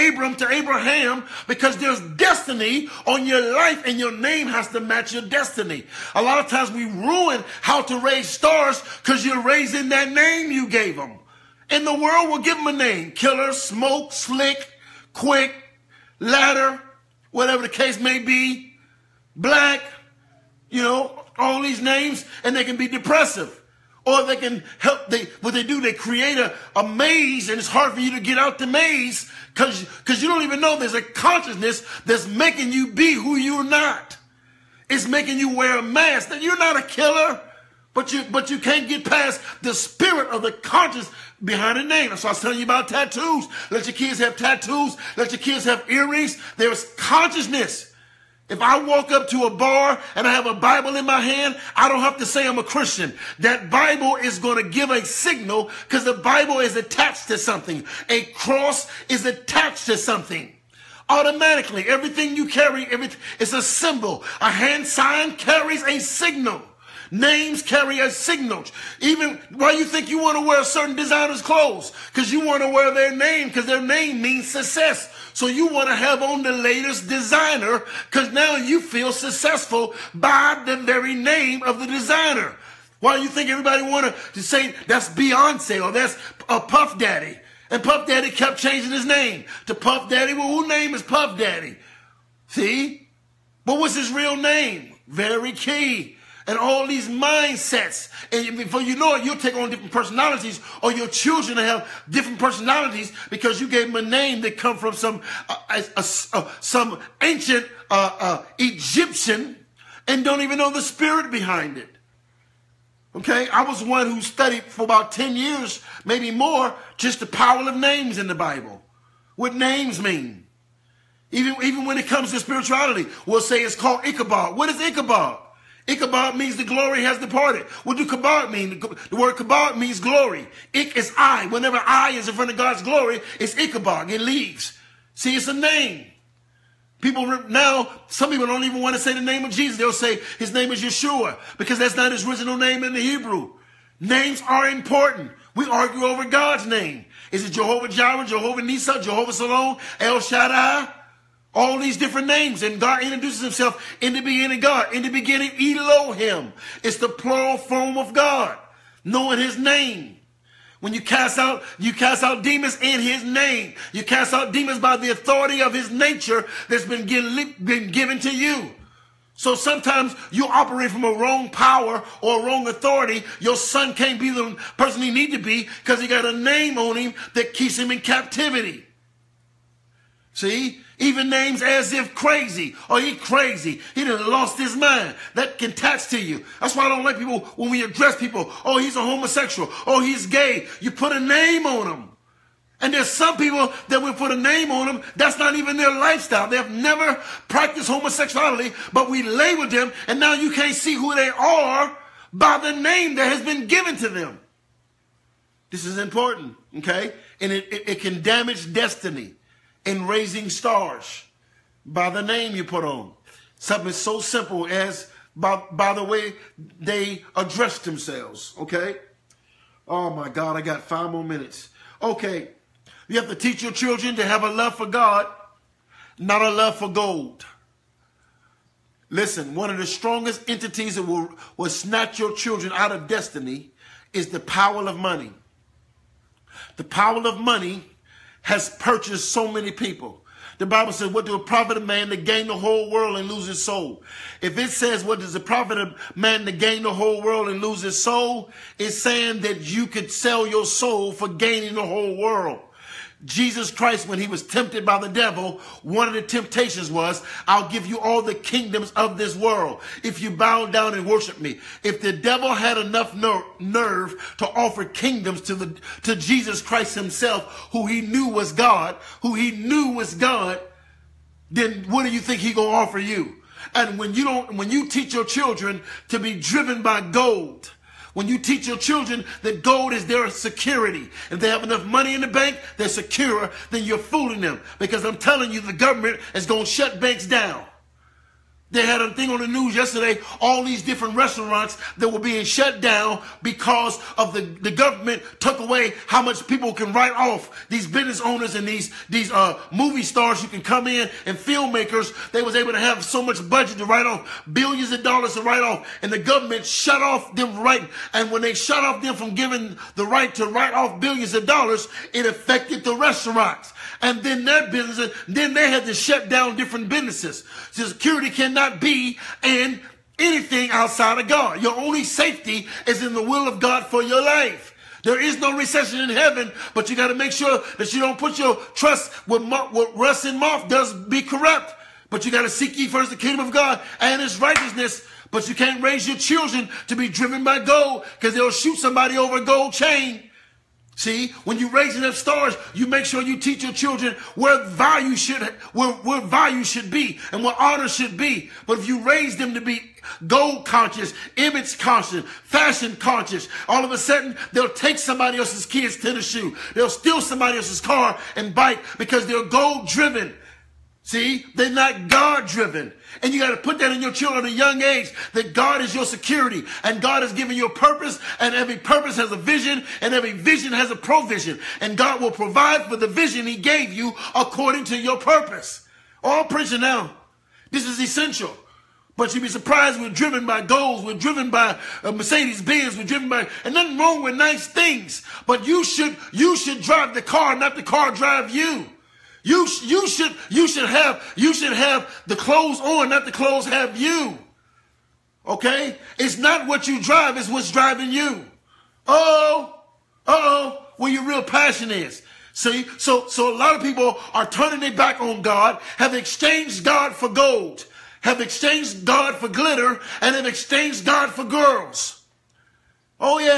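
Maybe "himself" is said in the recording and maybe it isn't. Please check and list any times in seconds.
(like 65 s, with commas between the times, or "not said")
153 s, 266 s.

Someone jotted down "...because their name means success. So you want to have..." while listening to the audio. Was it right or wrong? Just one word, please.
right.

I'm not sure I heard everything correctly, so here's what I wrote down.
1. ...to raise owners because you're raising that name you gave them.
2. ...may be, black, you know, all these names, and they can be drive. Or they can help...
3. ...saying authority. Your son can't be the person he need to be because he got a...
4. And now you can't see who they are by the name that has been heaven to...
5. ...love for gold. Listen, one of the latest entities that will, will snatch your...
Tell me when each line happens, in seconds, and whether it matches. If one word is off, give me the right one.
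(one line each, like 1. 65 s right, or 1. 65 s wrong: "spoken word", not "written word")
1. 7 s wrong: "stars", not "owners"
2. 17 s wrong: "depressive", not "drive"
3. 172 s wrong: "wrong", not "saying"
4. 200 s wrong: "given", not "heaven"
5. 226 s wrong: "strongest", not "latest".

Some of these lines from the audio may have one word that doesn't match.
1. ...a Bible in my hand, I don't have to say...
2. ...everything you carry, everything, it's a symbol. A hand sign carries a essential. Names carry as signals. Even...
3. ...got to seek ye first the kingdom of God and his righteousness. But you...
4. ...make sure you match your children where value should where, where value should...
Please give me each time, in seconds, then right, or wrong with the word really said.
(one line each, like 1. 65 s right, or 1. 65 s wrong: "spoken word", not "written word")
1. 50 s right
2. 61 s wrong: "signal", not "essential"
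3. 332 s right
4. 342 s wrong: "teach", not "match".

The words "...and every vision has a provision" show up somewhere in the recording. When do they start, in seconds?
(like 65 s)
369 s.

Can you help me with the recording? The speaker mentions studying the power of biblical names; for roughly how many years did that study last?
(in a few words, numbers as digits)
10.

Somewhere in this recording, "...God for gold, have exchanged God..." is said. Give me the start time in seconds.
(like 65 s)
406 s.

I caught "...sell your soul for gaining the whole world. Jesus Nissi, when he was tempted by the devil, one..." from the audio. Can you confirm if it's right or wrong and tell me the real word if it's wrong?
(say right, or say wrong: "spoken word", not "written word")
wrong: "Christ", not "Nissi".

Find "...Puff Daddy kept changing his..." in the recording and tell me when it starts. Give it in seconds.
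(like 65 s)
87 s.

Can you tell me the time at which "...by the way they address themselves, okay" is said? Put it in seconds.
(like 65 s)
215 s.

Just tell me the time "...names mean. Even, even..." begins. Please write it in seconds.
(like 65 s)
119 s.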